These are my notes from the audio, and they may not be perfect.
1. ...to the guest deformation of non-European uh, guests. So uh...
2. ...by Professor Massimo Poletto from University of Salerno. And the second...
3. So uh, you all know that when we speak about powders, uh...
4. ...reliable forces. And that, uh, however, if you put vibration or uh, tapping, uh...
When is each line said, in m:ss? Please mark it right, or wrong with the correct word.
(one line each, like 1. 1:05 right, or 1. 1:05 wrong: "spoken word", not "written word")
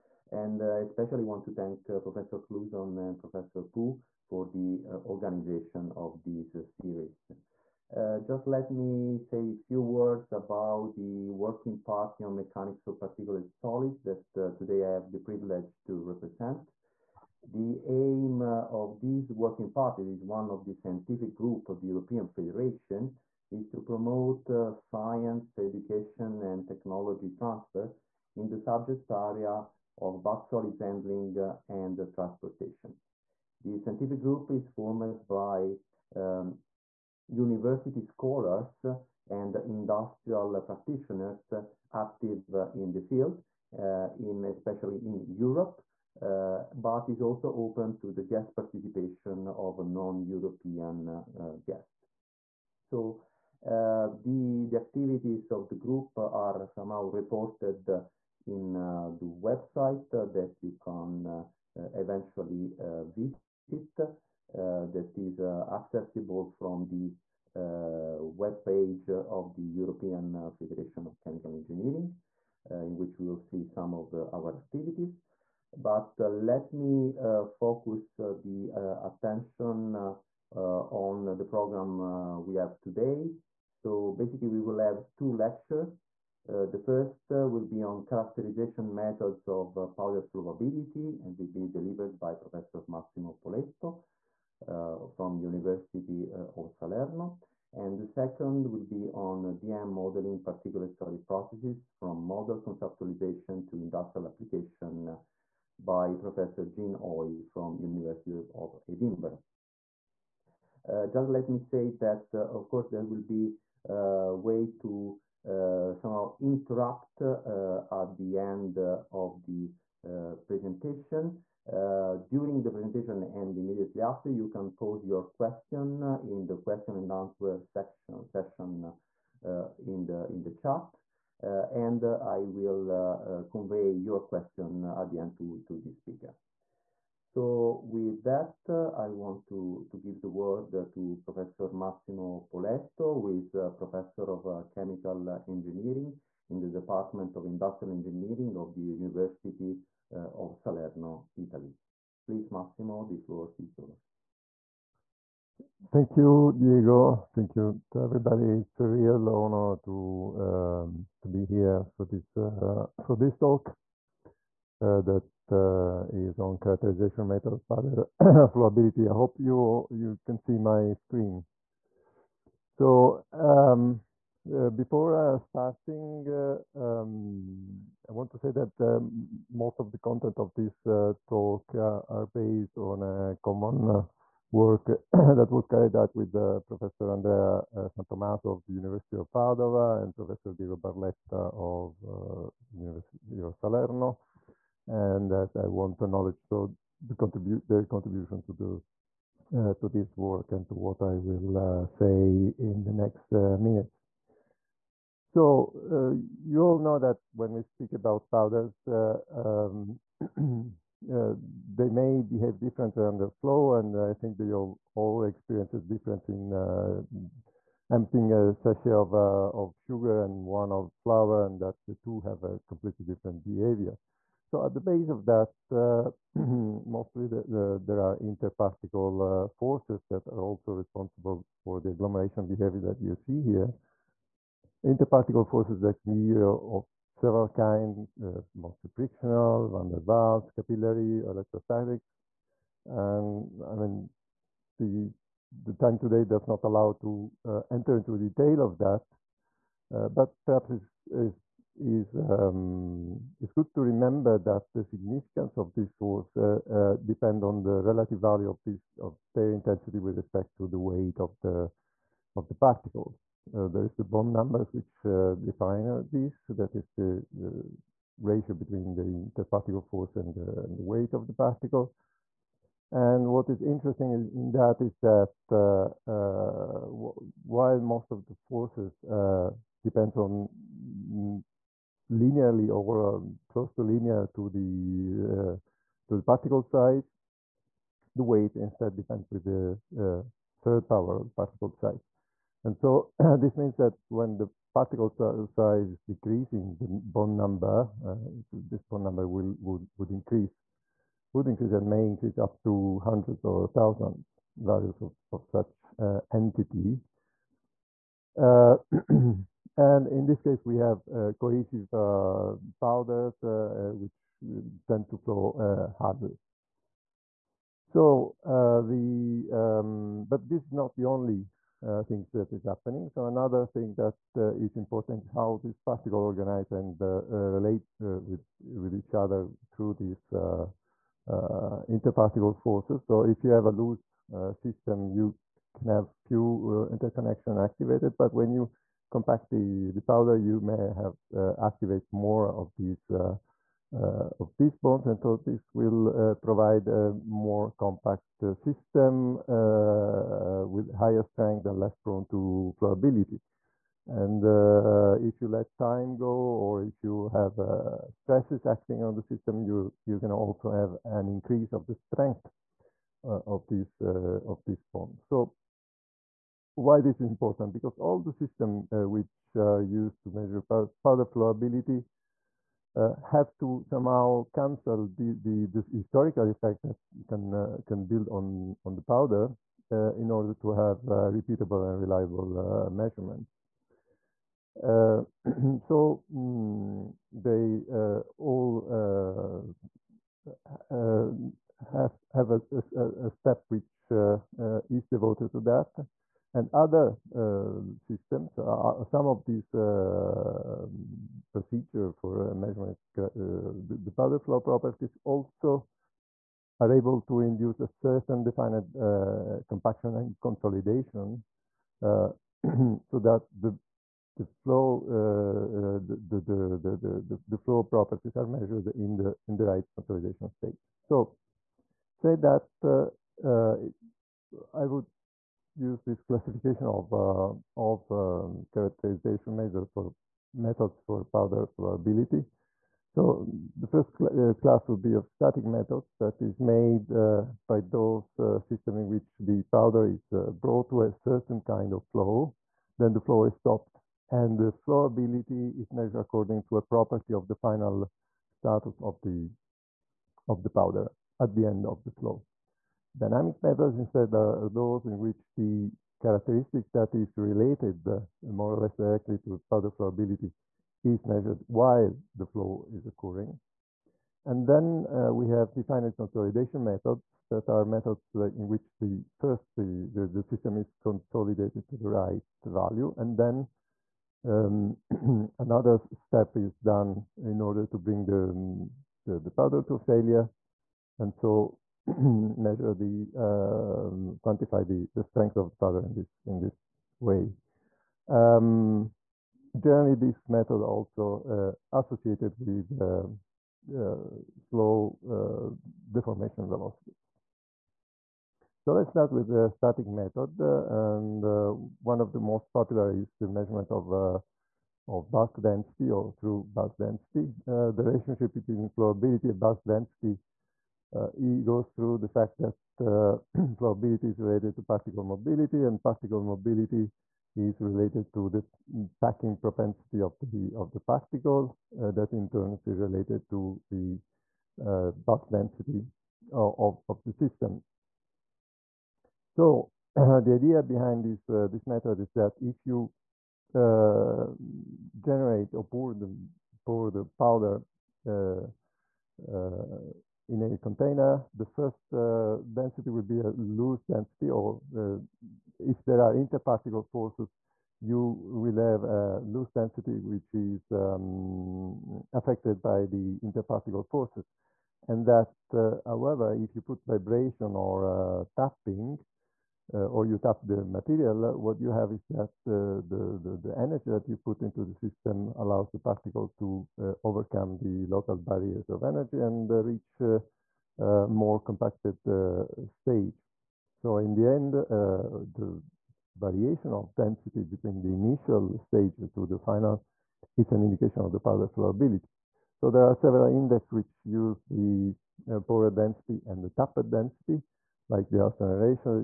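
1. 0:47 wrong: "participation", not "deformation"
2. 1:32 right
3. 3:25 right
4. 9:13 wrong: "interparticle", not "reliable".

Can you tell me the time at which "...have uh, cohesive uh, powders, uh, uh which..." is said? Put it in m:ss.
5:10.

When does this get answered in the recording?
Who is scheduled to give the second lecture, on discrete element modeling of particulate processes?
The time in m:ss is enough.
1:46.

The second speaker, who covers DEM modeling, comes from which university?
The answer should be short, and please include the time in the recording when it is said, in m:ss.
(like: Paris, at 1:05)
University of Edinburgh, at 1:47.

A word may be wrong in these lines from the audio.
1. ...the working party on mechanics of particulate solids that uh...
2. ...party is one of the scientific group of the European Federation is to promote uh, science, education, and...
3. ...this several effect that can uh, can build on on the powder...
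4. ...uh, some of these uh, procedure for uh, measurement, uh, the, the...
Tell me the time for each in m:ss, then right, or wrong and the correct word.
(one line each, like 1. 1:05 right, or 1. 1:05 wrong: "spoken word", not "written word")
1. 0:10 right
2. 0:19 right
3. 6:15 wrong: "historical", not "several"
4. 6:38 right.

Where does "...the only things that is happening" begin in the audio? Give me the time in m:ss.
5:20.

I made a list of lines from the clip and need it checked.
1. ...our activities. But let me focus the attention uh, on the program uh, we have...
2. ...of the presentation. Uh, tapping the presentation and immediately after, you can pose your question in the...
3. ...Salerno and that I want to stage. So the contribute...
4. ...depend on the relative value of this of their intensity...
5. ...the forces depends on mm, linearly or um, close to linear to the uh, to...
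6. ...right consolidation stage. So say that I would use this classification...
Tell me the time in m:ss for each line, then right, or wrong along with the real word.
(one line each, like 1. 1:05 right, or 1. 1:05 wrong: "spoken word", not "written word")
1. 1:14 right
2. 1:58 wrong: "during", not "tapping"
3. 3:13 wrong: "knowledge", not "stage"
4. 4:17 right
5. 4:38 right
6. 6:59 right.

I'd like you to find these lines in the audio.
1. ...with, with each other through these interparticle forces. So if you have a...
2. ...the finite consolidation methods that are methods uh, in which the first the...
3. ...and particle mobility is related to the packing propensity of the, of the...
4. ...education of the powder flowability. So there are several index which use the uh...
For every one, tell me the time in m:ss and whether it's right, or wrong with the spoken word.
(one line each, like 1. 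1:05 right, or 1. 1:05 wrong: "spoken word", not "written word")
1. 5:27 right
2. 7:45 right
3. 8:35 right
4. 9:40 wrong: "indication", not "education".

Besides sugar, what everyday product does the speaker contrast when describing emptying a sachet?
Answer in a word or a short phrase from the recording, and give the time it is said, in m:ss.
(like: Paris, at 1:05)
flour, at 3:41.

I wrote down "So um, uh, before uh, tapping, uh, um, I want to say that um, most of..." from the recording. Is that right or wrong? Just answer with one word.
wrong.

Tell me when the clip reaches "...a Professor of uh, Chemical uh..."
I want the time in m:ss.
2:23.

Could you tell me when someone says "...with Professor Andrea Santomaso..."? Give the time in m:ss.
3:06.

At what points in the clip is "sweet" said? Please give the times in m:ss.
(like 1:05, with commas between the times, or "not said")
not said.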